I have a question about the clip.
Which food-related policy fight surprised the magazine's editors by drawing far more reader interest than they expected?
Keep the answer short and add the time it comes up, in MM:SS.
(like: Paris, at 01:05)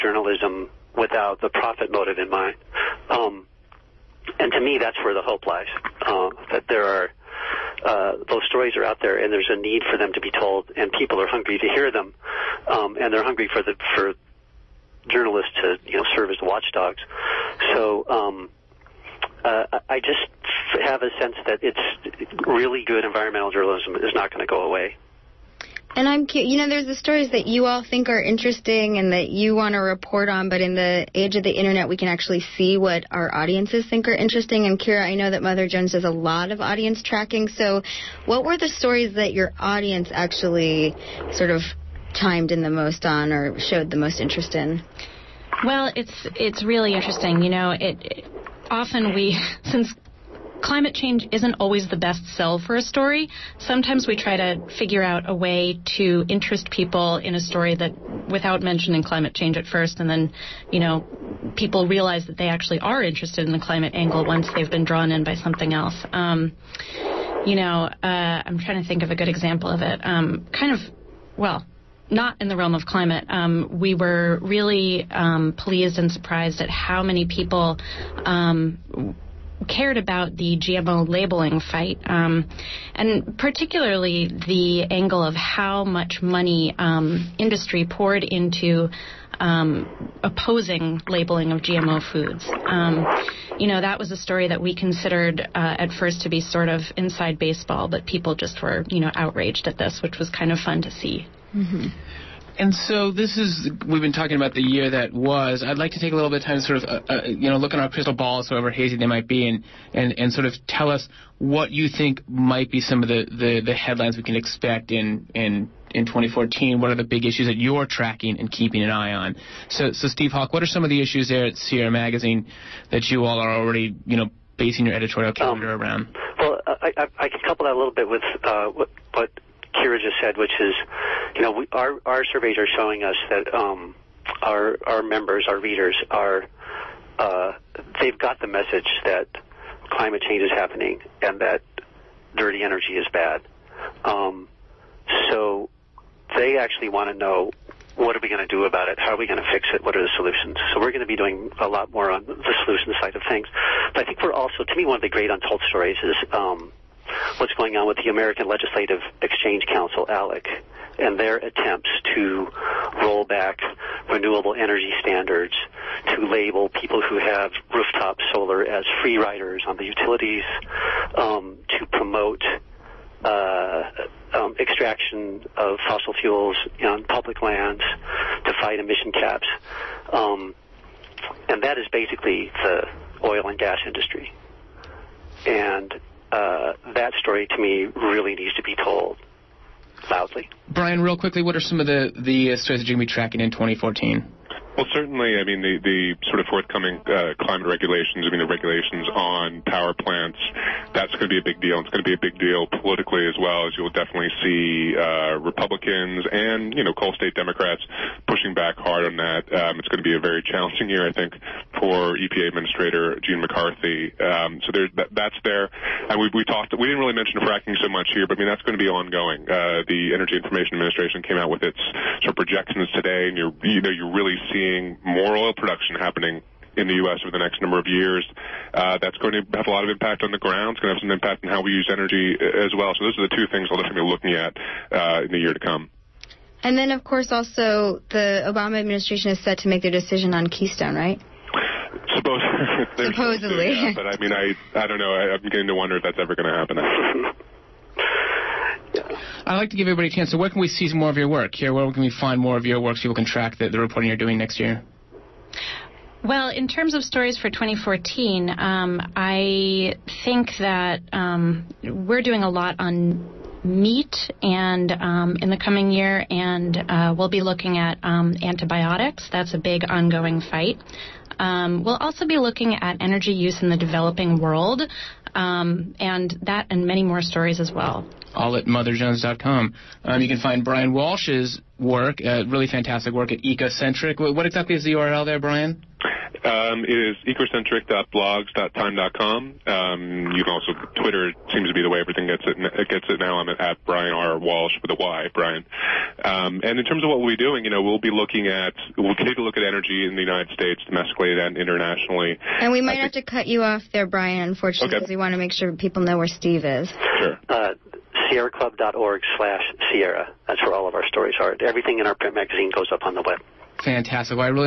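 GMO labeling, at 01:20.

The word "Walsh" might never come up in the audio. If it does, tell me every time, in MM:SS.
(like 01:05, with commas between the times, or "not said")
04:40, 04:54.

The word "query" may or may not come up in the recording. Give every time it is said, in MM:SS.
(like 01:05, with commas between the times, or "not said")
not said.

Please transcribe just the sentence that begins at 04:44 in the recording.
What, exactly is the URL there, Bryan?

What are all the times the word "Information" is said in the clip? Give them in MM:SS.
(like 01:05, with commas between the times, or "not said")
03:40.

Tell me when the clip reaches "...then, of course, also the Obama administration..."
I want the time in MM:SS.
03:56.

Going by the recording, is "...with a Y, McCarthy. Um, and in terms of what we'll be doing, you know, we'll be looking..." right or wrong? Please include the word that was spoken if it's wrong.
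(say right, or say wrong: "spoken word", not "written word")
wrong: "Bryan", not "McCarthy".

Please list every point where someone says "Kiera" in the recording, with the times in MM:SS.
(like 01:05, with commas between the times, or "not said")
00:34, 02:09.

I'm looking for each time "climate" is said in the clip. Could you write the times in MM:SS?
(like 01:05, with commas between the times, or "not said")
00:50, 00:59, 01:03, 01:12, 02:19, 03:17.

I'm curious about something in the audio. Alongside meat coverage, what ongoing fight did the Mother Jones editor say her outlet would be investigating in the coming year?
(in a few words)
antibiotics.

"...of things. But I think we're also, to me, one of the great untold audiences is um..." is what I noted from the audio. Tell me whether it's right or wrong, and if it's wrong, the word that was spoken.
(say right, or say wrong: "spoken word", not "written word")
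wrong: "stories", not "audiences".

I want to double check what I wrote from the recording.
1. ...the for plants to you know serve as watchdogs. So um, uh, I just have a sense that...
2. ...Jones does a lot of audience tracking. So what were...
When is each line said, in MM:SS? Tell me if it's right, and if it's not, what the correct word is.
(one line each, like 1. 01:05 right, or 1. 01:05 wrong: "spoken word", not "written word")
1. 00:13 wrong: "journalists", not "plants"
2. 00:35 right.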